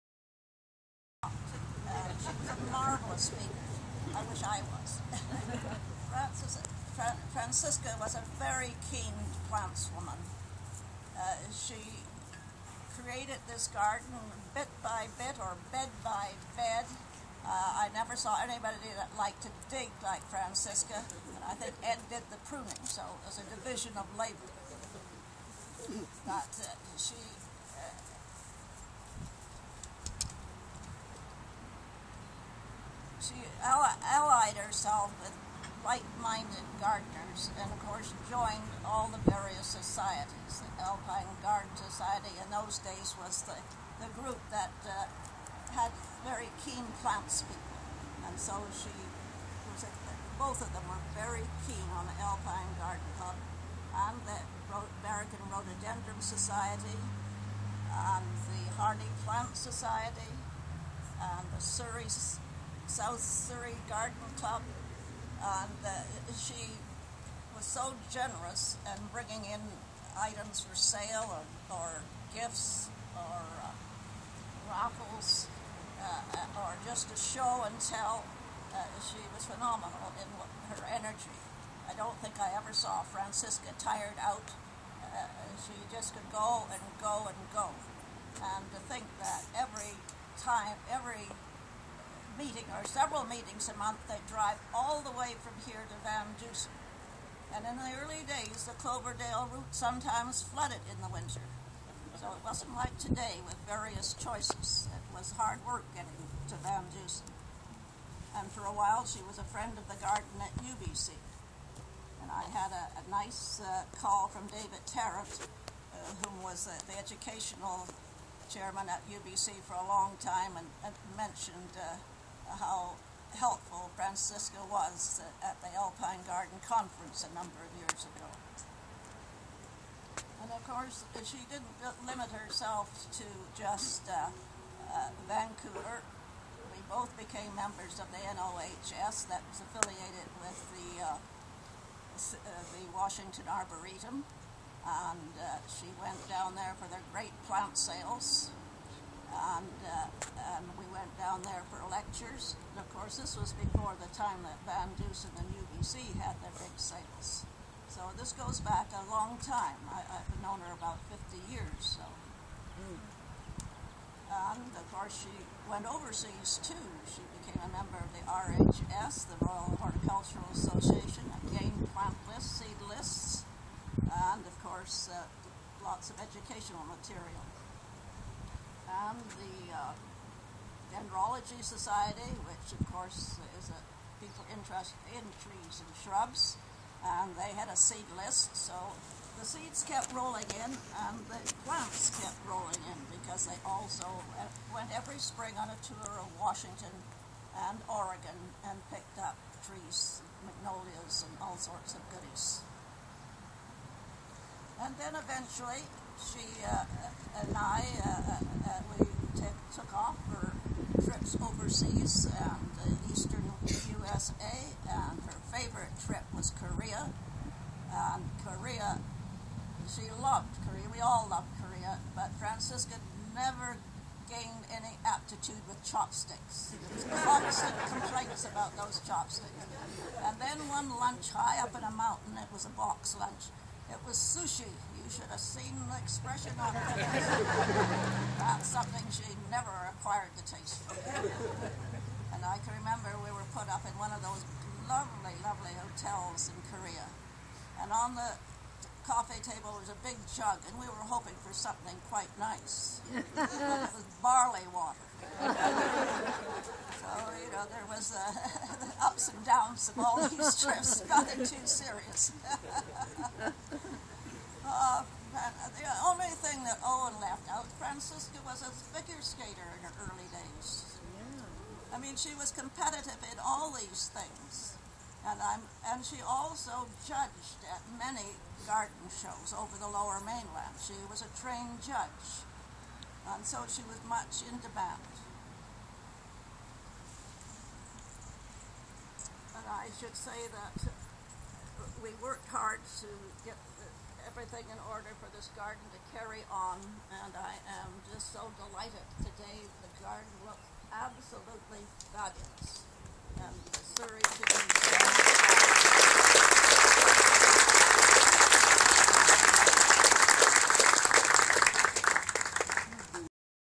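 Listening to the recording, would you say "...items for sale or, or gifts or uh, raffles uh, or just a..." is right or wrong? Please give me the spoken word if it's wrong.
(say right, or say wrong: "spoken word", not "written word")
right.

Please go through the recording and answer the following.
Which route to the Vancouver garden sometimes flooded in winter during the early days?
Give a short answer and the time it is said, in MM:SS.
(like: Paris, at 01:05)
Cloverdale, at 01:38.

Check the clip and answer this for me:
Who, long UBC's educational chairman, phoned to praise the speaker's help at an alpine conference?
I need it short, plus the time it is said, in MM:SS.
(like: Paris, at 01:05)
David Tarrant, at 01:54.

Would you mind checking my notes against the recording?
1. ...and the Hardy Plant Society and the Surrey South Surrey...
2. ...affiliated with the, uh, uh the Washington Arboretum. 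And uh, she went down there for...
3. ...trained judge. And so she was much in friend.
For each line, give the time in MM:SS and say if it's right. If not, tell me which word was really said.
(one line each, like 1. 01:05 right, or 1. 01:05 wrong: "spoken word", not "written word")
1. 00:57 right
2. 02:19 right
3. 04:41 wrong: "demand", not "friend".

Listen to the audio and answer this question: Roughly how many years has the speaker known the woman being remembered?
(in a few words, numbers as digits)
50.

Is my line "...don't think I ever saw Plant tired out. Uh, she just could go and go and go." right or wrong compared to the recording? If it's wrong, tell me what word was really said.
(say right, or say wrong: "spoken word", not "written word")
wrong: "Francisca", not "Plant".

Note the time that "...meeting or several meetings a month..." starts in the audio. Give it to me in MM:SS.
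01:32.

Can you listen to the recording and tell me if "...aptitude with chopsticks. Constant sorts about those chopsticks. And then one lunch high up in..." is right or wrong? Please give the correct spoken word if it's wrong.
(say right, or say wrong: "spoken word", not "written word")
wrong: "complaints", not "sorts".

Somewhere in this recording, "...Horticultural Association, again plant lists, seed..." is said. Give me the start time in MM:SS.
02:49.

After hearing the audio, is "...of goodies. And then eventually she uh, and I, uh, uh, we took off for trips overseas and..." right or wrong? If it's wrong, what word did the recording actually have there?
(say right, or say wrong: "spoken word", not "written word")
right.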